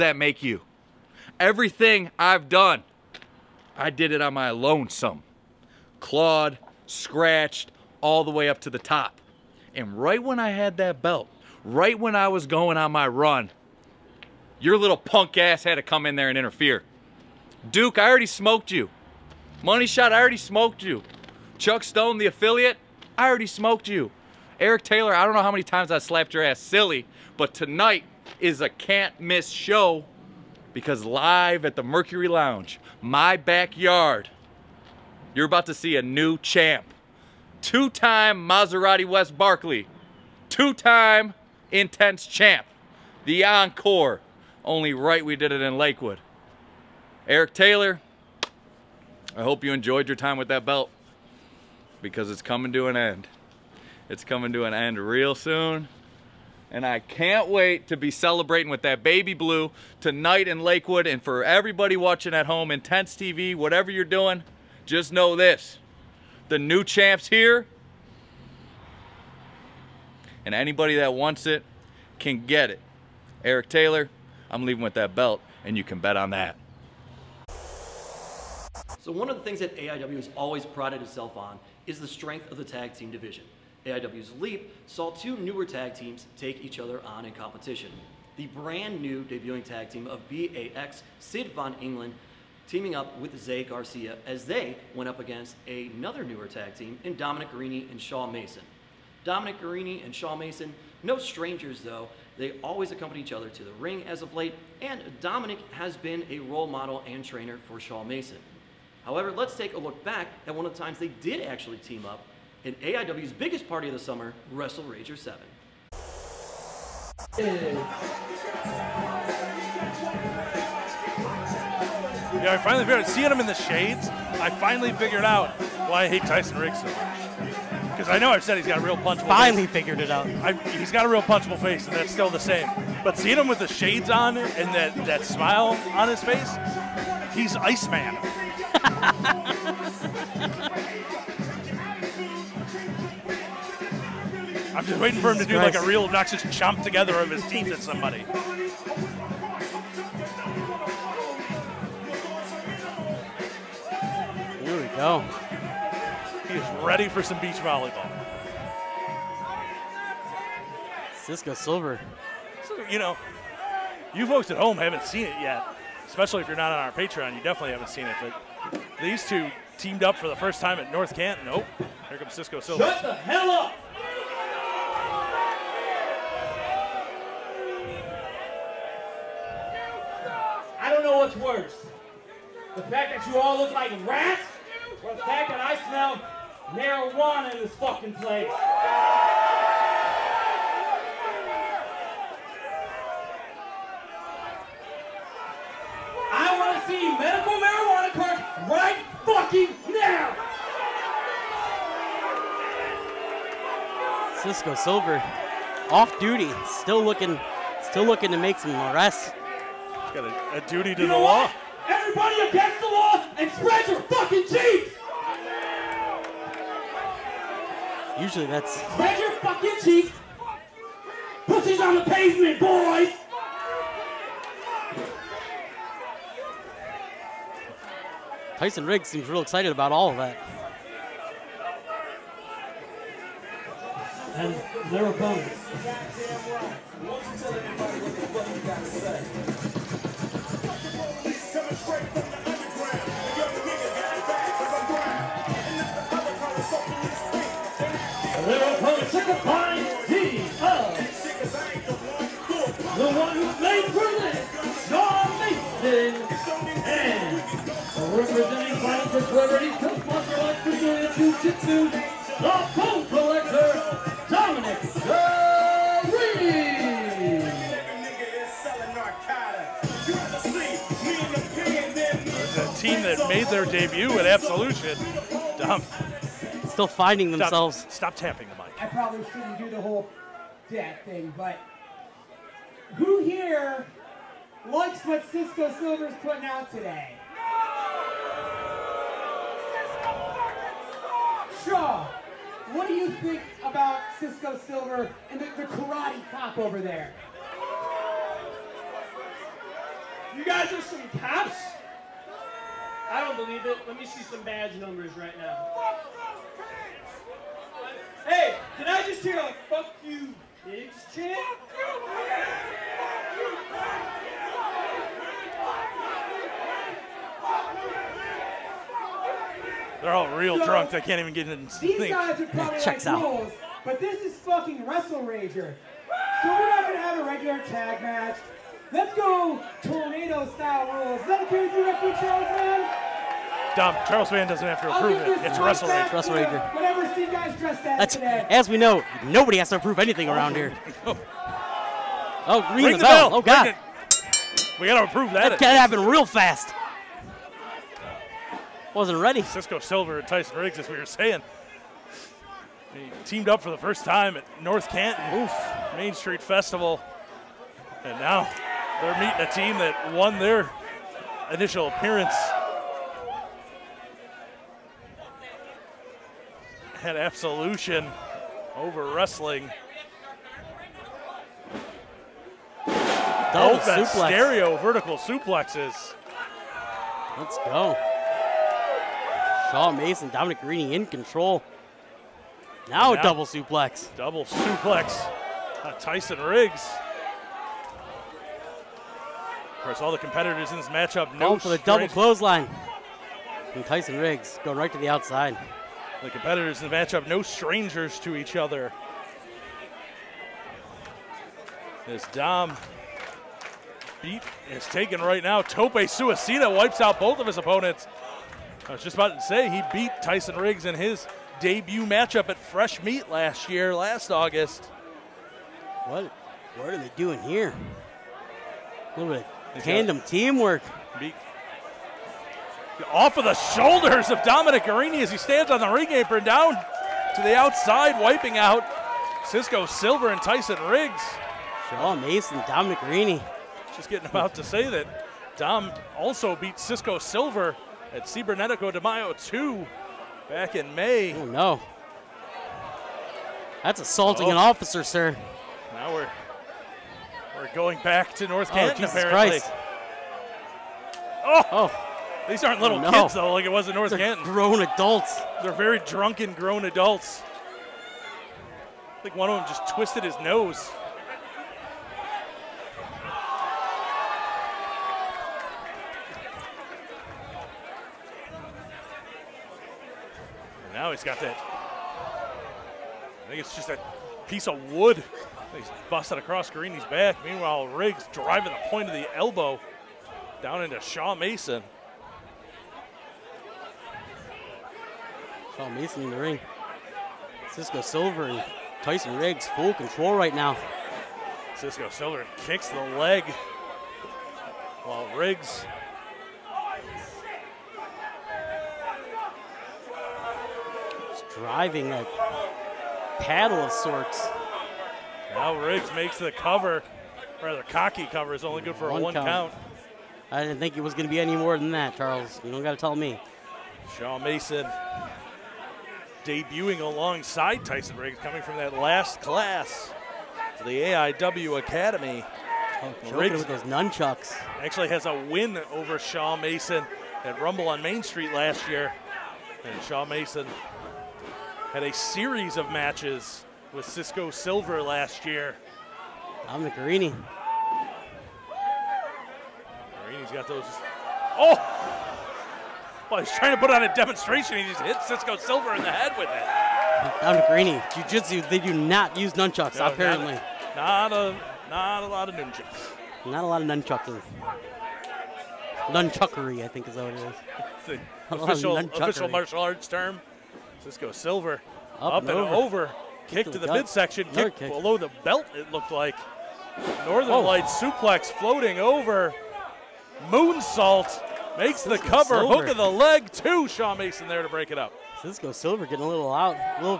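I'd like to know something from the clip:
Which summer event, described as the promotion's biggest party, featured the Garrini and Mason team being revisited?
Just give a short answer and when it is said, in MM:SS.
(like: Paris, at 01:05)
Wrestle Rager 7, at 01:54.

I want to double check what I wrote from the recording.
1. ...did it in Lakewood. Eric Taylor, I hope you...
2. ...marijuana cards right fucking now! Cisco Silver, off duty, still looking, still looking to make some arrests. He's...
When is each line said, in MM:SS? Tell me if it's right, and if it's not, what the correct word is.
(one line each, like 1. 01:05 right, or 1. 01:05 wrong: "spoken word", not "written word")
1. 00:45 right
2. 03:17 right.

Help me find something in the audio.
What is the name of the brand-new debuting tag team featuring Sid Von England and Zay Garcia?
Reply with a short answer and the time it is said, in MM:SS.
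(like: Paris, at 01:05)
BAX, at 01:30.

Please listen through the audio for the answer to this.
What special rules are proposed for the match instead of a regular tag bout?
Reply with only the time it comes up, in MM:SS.
05:29.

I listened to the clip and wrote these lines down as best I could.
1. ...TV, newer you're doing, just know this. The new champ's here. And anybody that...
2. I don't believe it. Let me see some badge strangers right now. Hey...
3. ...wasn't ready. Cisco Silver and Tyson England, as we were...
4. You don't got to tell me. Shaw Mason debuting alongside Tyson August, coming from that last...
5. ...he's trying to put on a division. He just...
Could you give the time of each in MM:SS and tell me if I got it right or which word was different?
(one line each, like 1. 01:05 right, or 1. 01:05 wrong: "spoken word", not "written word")
1. 01:03 wrong: "whatever", not "newer"
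2. 05:03 wrong: "numbers", not "strangers"
3. 05:48 wrong: "Riggs", not "England"
4. 08:32 wrong: "Riggs", not "August"
5. 09:03 wrong: "demonstration", not "division".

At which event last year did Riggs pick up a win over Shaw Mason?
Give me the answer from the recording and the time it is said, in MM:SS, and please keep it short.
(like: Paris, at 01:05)
Rumble on Main Street, at 08:47.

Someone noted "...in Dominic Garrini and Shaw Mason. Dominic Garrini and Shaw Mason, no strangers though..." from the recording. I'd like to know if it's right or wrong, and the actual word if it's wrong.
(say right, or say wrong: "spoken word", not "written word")
right.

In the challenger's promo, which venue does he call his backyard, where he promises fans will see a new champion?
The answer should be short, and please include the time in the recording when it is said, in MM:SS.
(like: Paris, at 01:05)
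Mercury Lounge, at 00:31.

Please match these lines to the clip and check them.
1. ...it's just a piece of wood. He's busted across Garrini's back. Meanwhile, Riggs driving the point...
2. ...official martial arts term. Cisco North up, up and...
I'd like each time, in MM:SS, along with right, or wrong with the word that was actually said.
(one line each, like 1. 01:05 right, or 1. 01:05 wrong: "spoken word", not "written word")
1. 07:53 right
2. 09:18 wrong: "Silver", not "North".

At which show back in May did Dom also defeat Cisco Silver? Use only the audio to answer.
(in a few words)
Cibernetico de Mayo 2.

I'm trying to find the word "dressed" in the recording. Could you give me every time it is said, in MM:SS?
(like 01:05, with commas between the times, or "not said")
05:37.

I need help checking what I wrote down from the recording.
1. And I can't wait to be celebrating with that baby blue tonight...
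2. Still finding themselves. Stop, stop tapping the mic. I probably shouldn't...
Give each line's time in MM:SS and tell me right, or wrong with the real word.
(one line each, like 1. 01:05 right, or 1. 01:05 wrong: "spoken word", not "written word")
1. 00:56 right
2. 04:36 right.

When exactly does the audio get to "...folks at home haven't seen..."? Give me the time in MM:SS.
02:44.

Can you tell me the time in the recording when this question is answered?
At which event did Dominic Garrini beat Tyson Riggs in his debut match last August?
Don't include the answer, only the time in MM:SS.
06:52.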